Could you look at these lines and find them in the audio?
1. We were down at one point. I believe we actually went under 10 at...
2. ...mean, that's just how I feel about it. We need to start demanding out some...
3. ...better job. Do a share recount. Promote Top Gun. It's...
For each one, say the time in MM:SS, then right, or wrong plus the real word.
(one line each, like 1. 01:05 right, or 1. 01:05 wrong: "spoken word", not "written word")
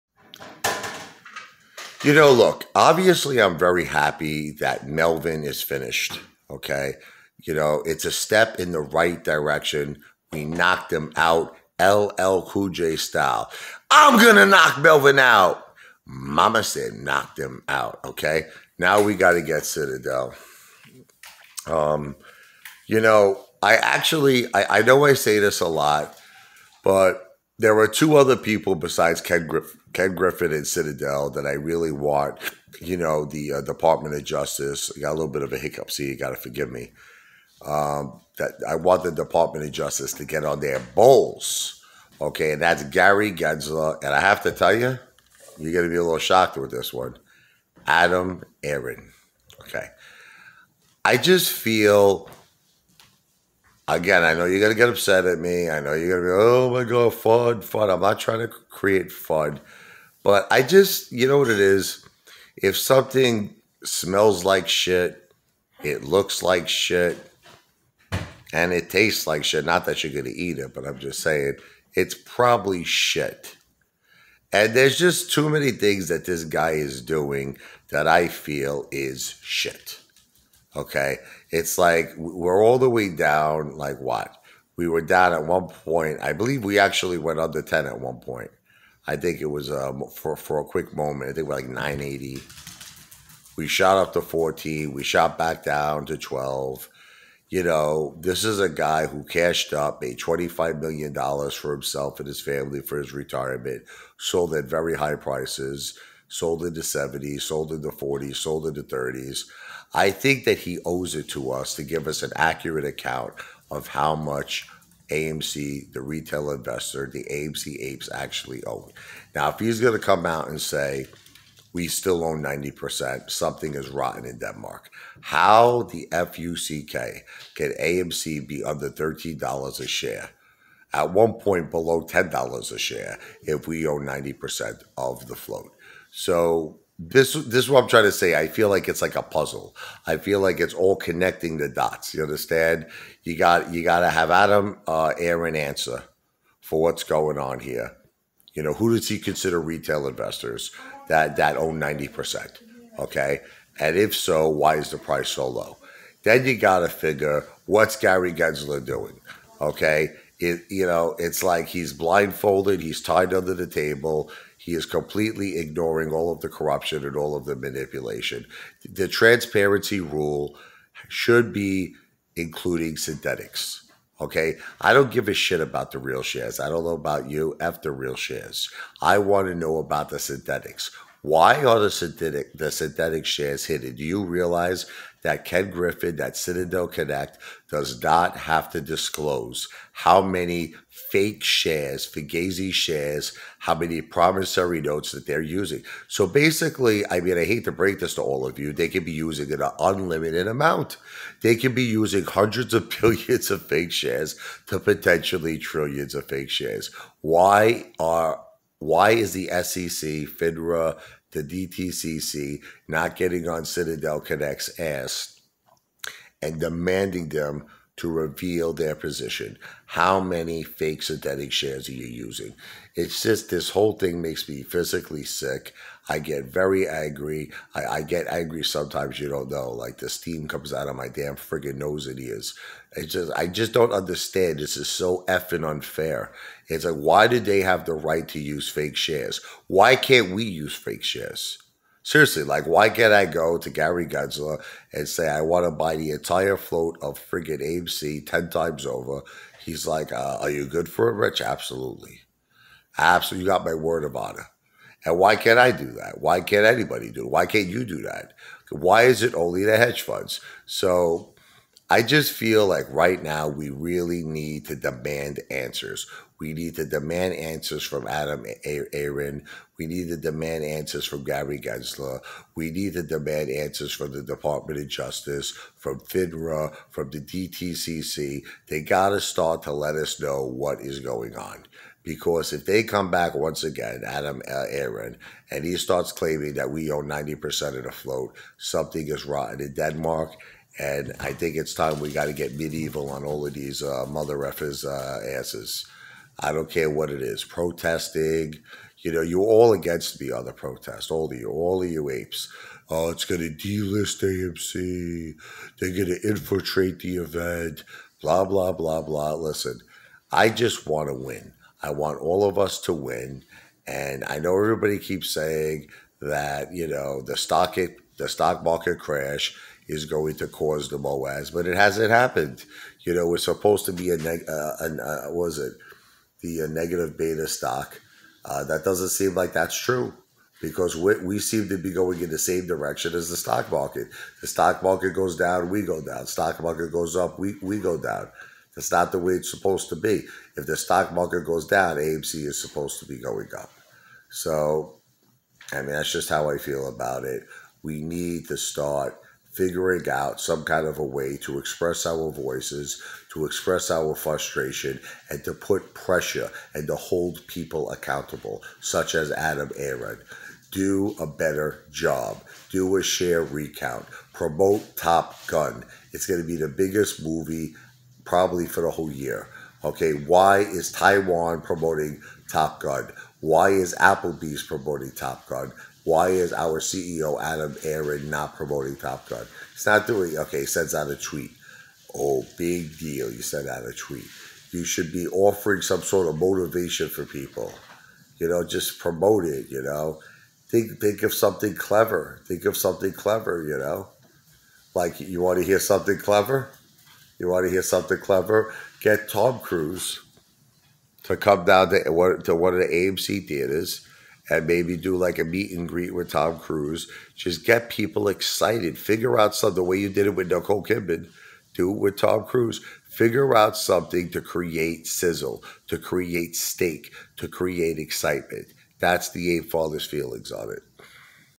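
1. 01:24 right
2. 05:45 wrong: "figuring", not "demanding"
3. 06:01 right.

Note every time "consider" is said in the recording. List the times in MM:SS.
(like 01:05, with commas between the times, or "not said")
02:29.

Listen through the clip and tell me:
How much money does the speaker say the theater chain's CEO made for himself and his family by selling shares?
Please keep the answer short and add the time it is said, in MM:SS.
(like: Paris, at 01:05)
$25 million, at 01:40.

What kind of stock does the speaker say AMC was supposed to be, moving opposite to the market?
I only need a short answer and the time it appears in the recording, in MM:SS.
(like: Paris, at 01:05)
negative beta stock, at 05:26.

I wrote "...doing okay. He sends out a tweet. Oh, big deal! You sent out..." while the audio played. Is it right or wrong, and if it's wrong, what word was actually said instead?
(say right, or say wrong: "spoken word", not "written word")
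right.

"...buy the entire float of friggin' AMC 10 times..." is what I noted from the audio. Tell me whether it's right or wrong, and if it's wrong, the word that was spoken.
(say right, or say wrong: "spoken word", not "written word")
right.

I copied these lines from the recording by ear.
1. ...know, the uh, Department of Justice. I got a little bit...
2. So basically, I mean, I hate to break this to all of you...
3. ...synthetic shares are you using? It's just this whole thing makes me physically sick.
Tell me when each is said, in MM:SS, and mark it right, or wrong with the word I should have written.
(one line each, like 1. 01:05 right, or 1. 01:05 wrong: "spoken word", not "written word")
1. 00:32 right
2. 03:16 right
3. 03:41 right.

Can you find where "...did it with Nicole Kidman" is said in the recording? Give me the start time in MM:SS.
06:50.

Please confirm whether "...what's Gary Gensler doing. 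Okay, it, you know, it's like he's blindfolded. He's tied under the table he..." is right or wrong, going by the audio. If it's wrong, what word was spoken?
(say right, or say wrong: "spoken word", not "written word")
right.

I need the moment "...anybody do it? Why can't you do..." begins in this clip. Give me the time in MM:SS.
04:16.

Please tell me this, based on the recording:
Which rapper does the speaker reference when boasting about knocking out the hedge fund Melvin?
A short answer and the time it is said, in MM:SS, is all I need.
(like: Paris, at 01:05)
LL Cool J, at 00:11.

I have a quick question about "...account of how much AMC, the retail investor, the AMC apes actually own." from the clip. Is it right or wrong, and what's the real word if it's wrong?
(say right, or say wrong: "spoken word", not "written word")
right.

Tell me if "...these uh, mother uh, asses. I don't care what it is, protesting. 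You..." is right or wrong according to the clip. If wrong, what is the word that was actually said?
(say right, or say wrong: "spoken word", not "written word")
right.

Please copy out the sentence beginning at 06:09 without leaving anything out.
Okay, why is Taiwan promoting Top Gun?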